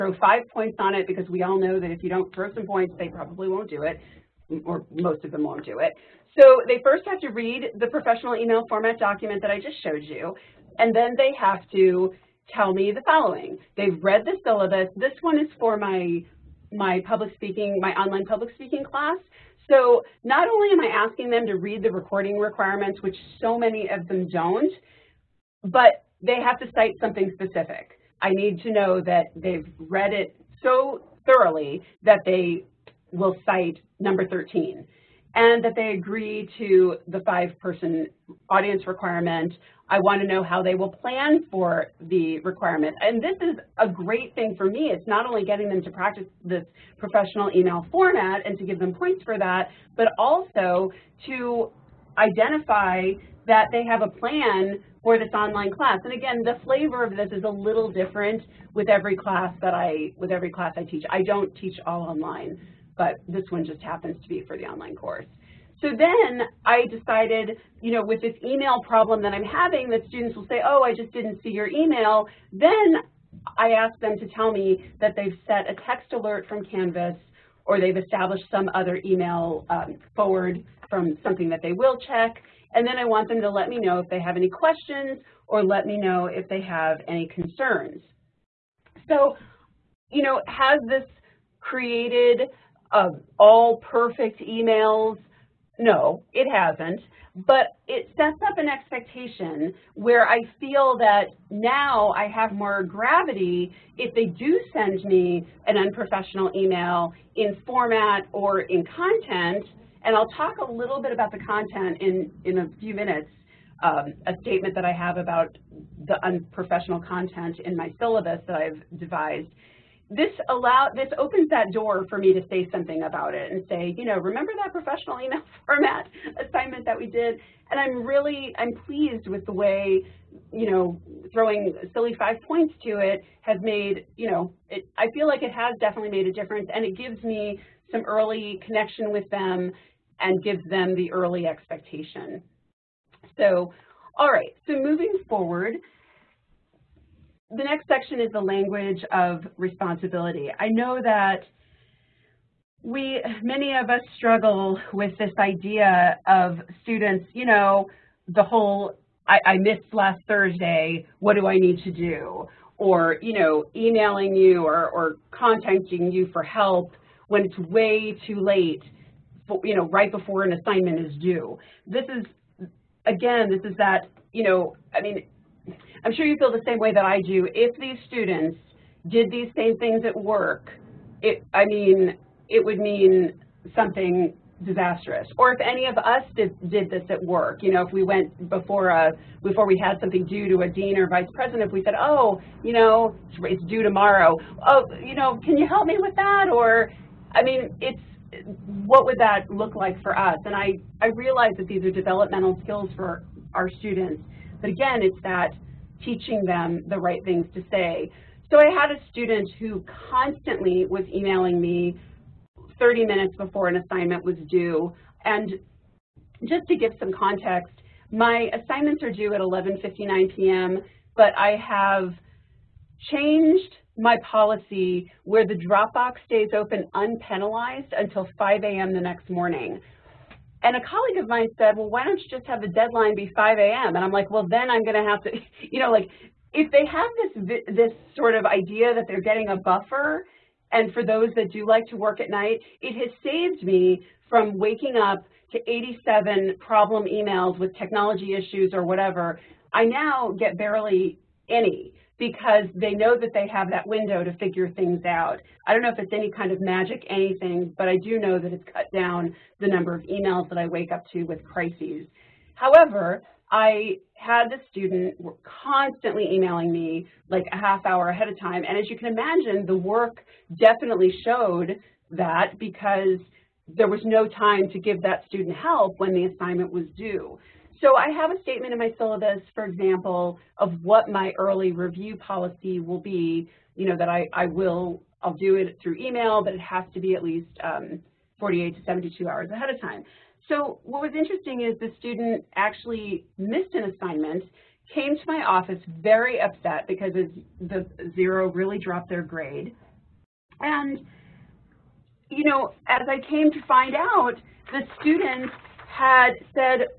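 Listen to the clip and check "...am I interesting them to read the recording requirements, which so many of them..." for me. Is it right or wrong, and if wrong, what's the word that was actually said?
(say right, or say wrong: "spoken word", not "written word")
wrong: "asking", not "interesting".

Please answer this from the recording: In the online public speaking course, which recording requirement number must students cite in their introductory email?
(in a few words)
13.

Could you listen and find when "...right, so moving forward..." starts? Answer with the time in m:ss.
2:24.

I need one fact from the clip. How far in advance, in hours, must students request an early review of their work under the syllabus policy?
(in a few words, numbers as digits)
48 to 72 hours.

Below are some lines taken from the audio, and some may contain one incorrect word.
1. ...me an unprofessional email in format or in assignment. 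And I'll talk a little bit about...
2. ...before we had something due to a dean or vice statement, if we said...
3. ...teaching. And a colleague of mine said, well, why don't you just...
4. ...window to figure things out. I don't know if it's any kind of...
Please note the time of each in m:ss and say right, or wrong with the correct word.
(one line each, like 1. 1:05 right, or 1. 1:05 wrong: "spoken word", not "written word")
1. 1:45 wrong: "content", not "assignment"
2. 3:09 wrong: "president", not "statement"
3. 3:49 wrong: "morning", not "teaching"
4. 4:13 right.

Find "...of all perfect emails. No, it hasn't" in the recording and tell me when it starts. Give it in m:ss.
1:32.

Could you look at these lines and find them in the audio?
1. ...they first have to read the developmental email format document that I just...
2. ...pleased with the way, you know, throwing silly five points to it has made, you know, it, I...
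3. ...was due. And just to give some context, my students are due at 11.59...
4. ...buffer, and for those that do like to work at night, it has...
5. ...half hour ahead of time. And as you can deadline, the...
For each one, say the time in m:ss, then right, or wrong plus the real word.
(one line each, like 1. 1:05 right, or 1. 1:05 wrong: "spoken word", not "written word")
1. 0:06 wrong: "professional", not "developmental"
2. 2:08 right
3. 3:34 wrong: "assignments", not "students"
4. 3:59 right
5. 4:27 wrong: "imagine", not "deadline".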